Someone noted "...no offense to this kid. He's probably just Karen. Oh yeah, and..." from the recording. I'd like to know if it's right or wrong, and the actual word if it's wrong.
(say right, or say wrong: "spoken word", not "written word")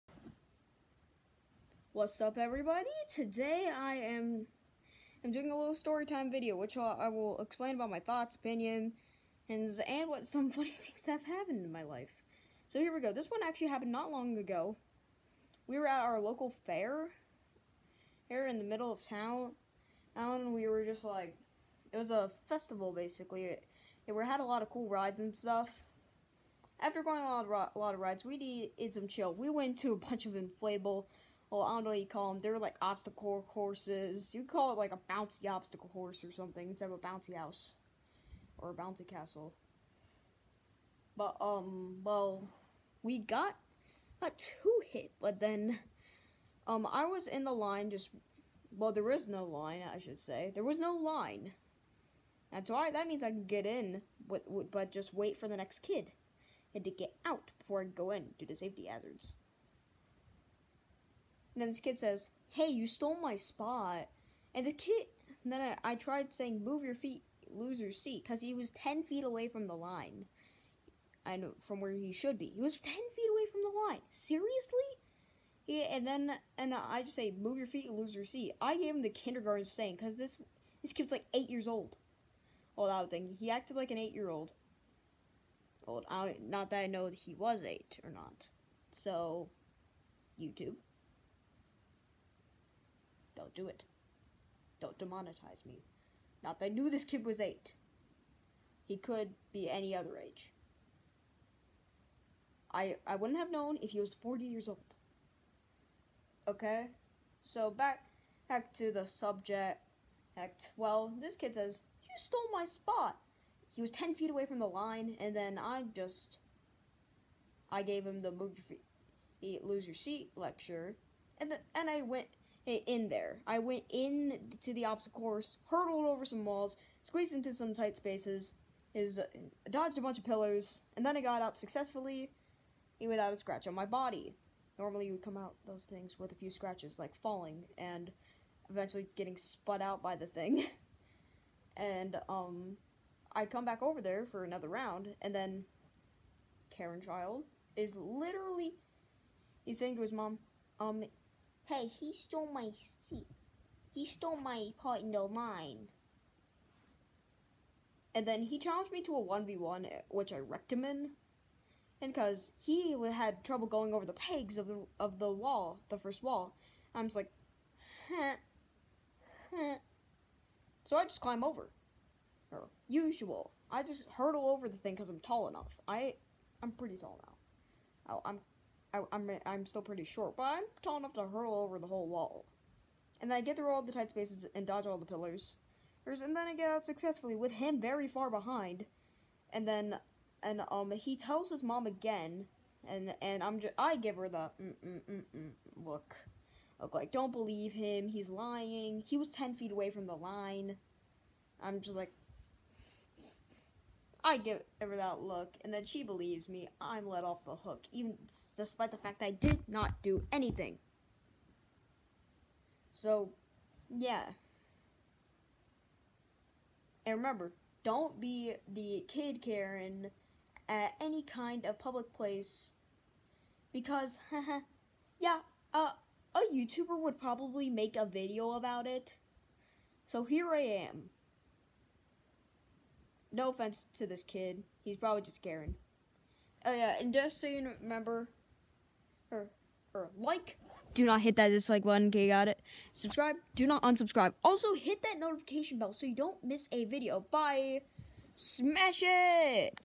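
right.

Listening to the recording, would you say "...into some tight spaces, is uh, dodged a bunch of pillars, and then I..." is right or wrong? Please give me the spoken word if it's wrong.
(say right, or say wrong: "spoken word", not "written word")
right.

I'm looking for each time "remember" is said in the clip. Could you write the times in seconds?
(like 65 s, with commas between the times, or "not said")
217 s, 237 s.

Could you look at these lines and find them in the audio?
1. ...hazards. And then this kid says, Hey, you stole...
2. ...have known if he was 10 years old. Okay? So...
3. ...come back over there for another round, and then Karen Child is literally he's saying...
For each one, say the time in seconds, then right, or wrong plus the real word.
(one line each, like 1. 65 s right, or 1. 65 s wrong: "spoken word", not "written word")
1. 58 s right
2. 103 s wrong: "40", not "10"
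3. 143 s right.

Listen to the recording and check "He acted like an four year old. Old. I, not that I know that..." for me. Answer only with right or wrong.
wrong.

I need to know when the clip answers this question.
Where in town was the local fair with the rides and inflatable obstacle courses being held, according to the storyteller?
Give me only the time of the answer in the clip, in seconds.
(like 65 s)
18 s.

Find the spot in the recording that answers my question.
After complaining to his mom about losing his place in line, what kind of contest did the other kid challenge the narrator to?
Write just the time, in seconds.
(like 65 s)
159 s.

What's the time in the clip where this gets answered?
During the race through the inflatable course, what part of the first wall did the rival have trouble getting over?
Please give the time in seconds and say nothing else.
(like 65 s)
164 s.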